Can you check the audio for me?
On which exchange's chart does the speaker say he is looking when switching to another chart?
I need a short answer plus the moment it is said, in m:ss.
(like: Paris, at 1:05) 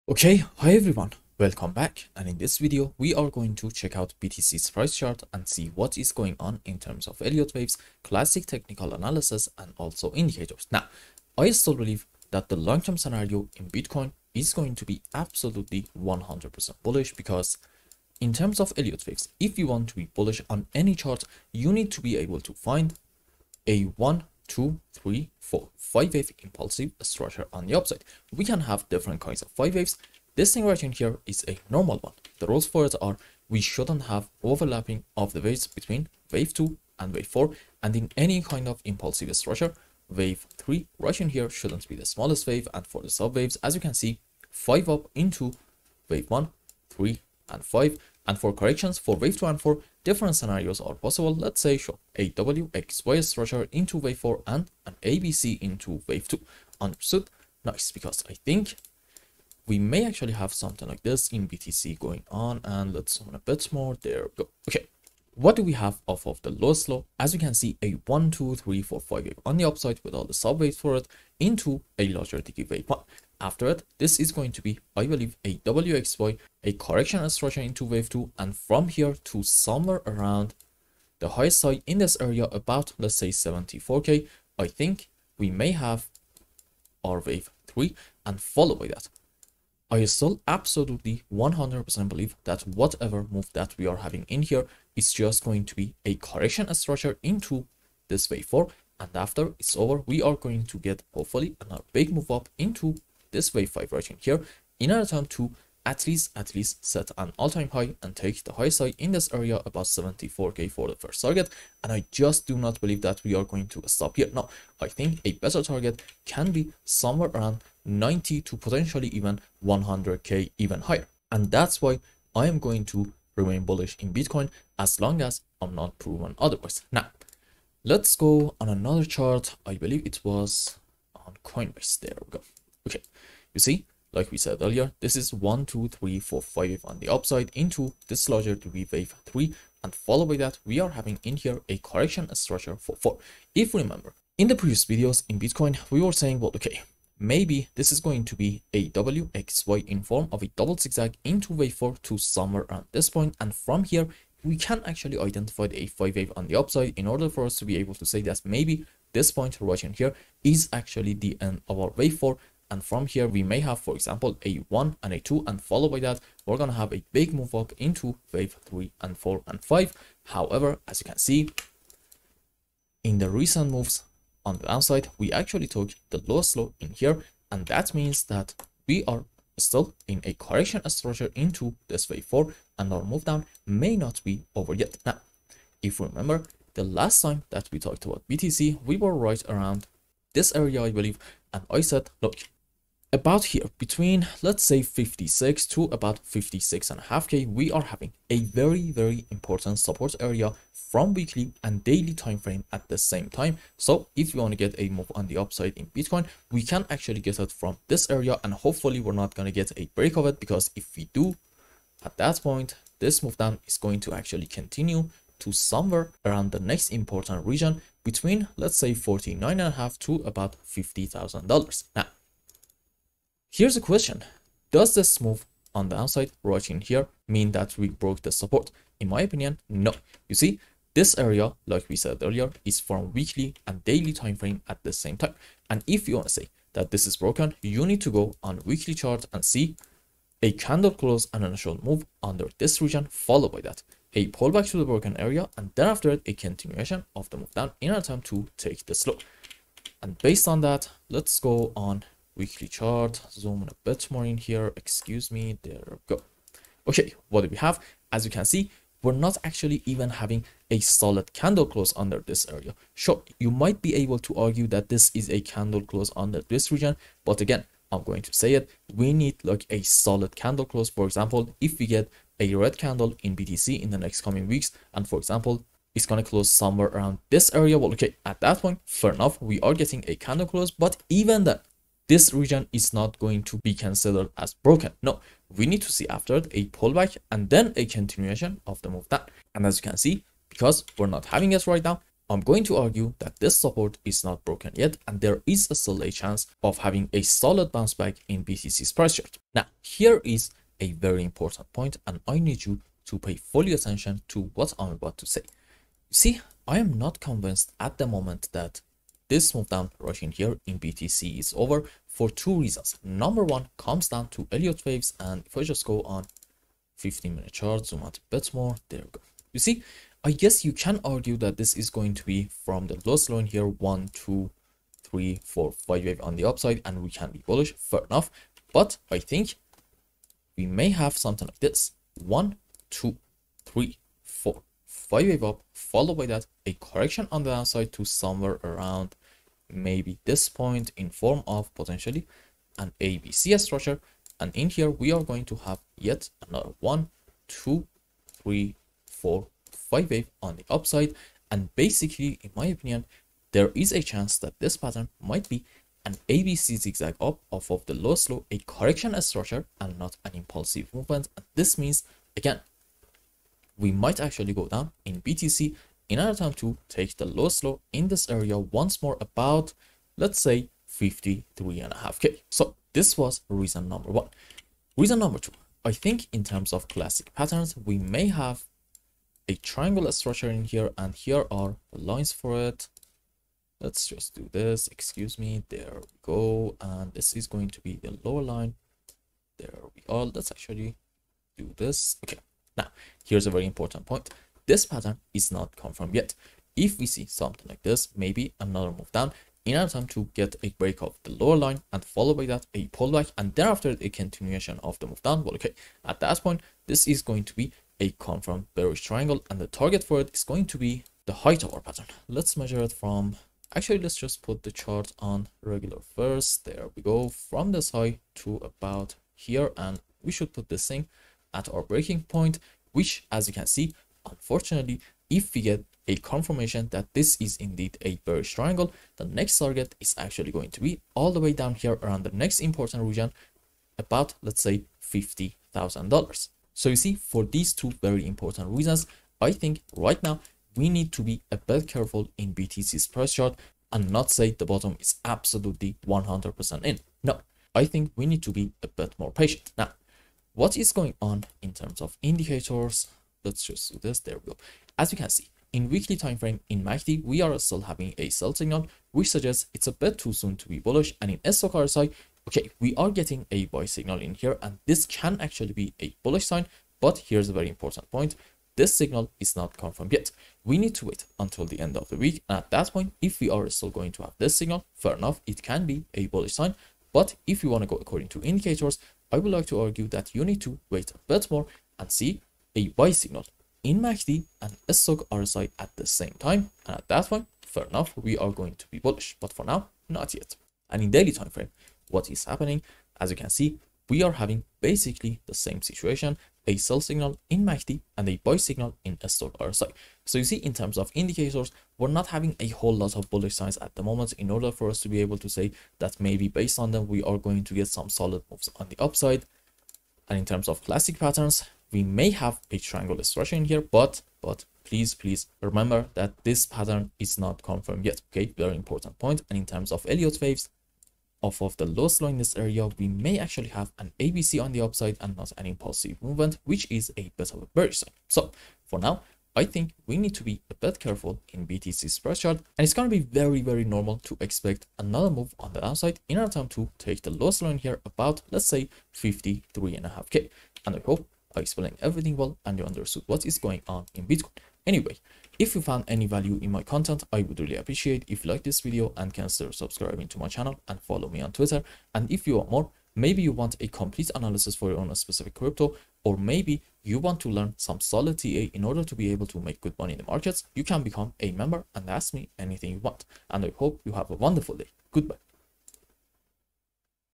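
Coinbase, at 2:11.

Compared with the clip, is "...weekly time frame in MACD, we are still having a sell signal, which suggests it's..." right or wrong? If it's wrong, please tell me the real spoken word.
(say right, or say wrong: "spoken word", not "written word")
right.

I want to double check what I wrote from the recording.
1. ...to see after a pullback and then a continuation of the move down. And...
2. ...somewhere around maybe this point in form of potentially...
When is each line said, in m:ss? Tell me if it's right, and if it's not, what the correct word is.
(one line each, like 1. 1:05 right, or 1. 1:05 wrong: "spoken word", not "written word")
1. 4:45 right
2. 5:38 right.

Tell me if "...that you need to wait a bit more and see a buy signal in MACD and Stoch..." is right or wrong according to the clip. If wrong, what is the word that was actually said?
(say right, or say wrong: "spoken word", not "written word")
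right.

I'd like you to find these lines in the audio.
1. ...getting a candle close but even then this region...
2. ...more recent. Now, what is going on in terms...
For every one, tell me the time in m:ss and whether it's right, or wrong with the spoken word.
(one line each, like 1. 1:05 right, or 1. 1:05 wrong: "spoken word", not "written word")
1. 4:39 right
2. 7:29 wrong: "patient", not "recent".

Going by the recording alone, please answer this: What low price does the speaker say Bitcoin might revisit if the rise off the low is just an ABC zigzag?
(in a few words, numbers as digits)
53.5k.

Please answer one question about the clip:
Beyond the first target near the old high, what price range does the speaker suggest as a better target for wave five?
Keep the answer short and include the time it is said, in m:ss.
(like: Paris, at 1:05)
90 to 100k, at 1:57.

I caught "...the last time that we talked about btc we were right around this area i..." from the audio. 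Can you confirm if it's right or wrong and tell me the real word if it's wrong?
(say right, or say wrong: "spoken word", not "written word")
right.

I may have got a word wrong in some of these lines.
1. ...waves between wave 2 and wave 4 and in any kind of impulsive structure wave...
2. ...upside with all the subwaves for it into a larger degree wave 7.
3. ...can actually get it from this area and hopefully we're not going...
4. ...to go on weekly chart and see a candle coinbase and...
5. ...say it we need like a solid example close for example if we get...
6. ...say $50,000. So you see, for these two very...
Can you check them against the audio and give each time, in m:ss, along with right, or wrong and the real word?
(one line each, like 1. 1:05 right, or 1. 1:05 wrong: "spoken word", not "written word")
1. 0:35 right
2. 1:09 wrong: "1", not "7"
3. 3:26 right
4. 3:58 wrong: "close", not "coinbase"
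5. 4:28 wrong: "candle", not "example"
6. 7:14 right.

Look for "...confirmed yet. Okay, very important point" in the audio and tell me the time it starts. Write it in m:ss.
8:37.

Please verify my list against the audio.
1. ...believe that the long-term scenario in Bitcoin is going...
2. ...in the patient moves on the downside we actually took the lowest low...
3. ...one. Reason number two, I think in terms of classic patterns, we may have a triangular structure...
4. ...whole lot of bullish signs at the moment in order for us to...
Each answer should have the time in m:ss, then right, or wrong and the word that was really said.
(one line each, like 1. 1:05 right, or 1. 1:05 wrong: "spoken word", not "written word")
1. 0:11 right
2. 2:53 wrong: "recent", not "patient"
3. 6:14 right
4. 8:22 right.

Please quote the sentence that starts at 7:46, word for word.
But here's a very important point.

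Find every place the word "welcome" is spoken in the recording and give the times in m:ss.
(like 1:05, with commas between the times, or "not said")
0:01.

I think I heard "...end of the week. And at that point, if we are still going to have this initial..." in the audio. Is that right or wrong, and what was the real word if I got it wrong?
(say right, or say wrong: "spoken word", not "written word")
wrong: "signal", not "initial".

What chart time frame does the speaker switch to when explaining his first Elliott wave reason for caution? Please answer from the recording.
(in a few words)
15 minute.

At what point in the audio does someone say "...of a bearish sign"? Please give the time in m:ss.
8:47.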